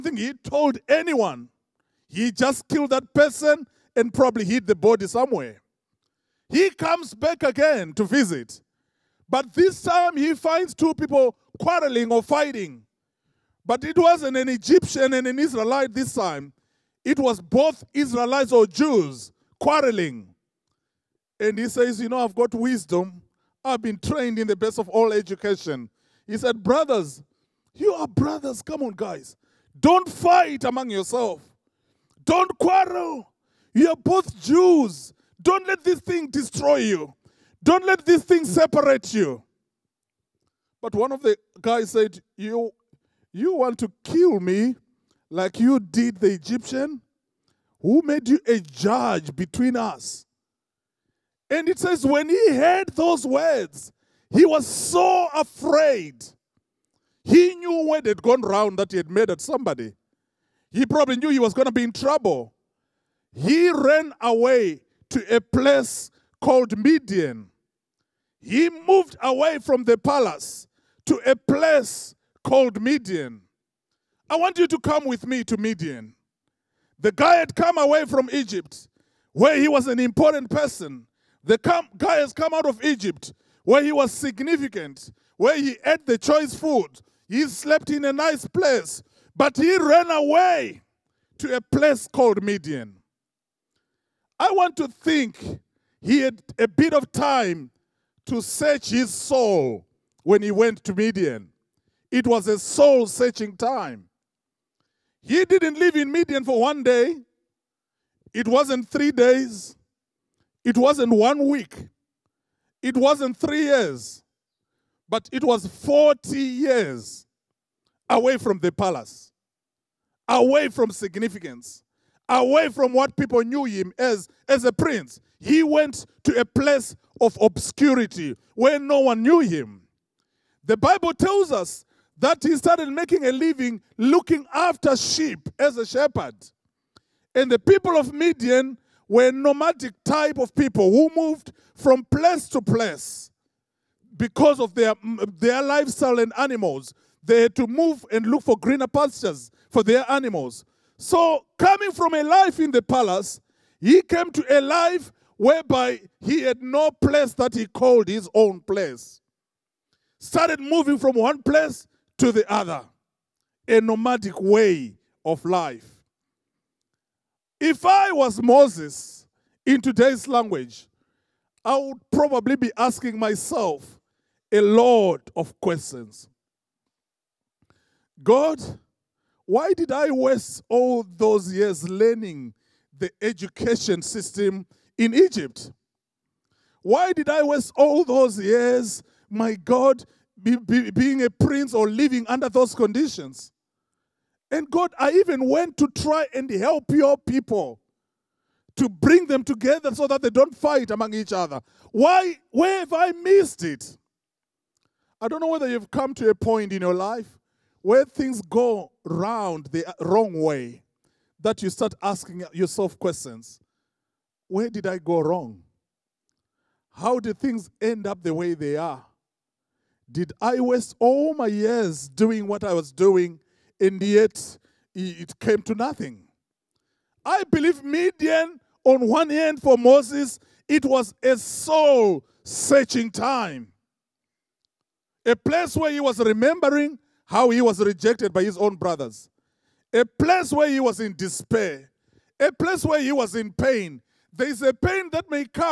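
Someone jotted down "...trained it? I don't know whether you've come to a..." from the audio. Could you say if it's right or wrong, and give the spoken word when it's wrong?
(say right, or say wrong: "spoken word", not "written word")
wrong: "missed", not "trained".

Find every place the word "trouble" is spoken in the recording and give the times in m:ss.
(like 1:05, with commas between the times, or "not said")
1:01.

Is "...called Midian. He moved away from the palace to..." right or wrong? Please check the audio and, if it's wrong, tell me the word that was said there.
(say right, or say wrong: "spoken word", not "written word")
right.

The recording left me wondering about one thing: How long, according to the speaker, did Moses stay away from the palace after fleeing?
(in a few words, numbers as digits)
40 years.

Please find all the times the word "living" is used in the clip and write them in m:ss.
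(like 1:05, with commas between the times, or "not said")
2:13, 3:11.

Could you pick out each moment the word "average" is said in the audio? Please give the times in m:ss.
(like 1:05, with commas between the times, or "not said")
not said.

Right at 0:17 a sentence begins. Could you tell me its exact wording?
It was both Israelites or Jews quarreling.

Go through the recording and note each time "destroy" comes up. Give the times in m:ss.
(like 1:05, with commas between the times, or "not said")
0:36.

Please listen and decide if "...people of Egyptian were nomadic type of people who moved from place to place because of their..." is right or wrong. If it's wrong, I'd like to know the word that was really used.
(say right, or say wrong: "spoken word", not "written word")
wrong: "Midian", not "Egyptian".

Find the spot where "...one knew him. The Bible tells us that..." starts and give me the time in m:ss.
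2:09.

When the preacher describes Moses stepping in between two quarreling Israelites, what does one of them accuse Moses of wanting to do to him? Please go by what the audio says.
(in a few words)
Kill me.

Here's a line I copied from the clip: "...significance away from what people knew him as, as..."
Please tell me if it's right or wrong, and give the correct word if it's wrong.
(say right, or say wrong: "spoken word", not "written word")
right.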